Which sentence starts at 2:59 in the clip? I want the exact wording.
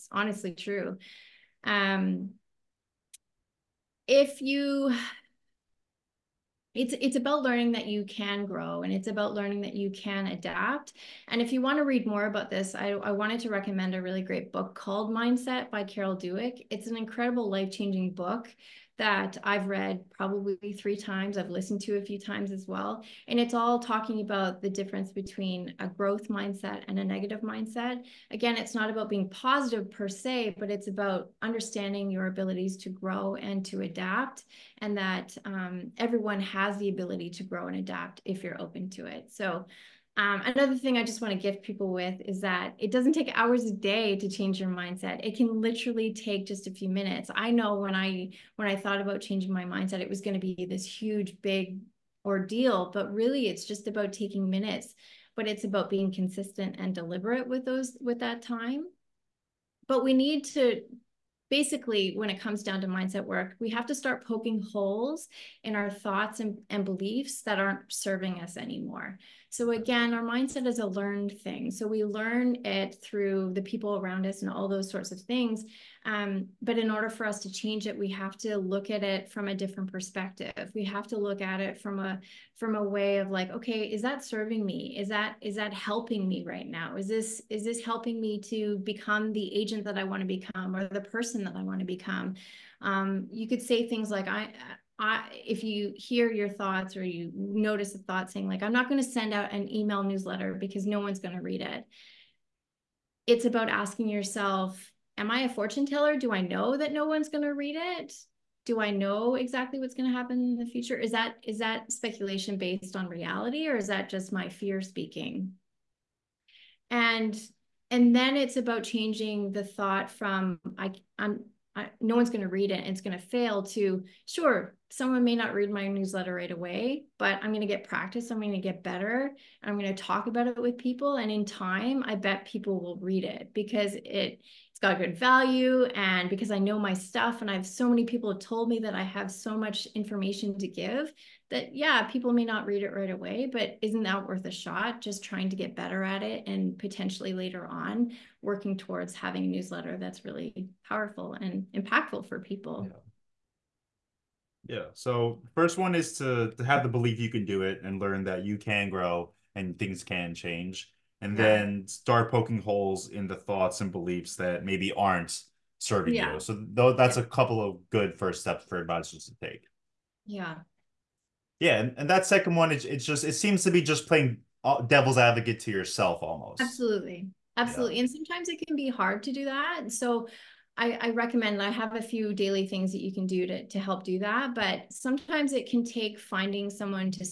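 So I, I, recommend I have a few daily things that you can do to, to help do that.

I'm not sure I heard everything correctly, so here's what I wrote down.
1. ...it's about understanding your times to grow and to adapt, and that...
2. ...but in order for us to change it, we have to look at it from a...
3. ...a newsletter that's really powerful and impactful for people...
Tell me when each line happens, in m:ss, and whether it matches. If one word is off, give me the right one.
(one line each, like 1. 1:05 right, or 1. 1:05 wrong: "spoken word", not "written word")
1. 0:30 wrong: "abilities", not "times"
2. 1:16 right
3. 2:29 right.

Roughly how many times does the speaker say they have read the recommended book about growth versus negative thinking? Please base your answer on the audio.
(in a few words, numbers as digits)
3.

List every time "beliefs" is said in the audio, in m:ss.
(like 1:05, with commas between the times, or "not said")
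1:06, 2:36, 2:43.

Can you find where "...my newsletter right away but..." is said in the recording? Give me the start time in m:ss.
2:05.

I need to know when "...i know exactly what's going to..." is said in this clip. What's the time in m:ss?
1:48.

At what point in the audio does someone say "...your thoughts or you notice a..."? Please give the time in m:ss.
1:36.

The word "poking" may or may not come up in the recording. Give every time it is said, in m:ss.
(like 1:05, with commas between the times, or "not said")
1:04, 2:42.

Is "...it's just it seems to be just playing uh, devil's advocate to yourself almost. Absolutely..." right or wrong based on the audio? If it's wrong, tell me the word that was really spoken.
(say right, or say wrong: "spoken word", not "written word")
right.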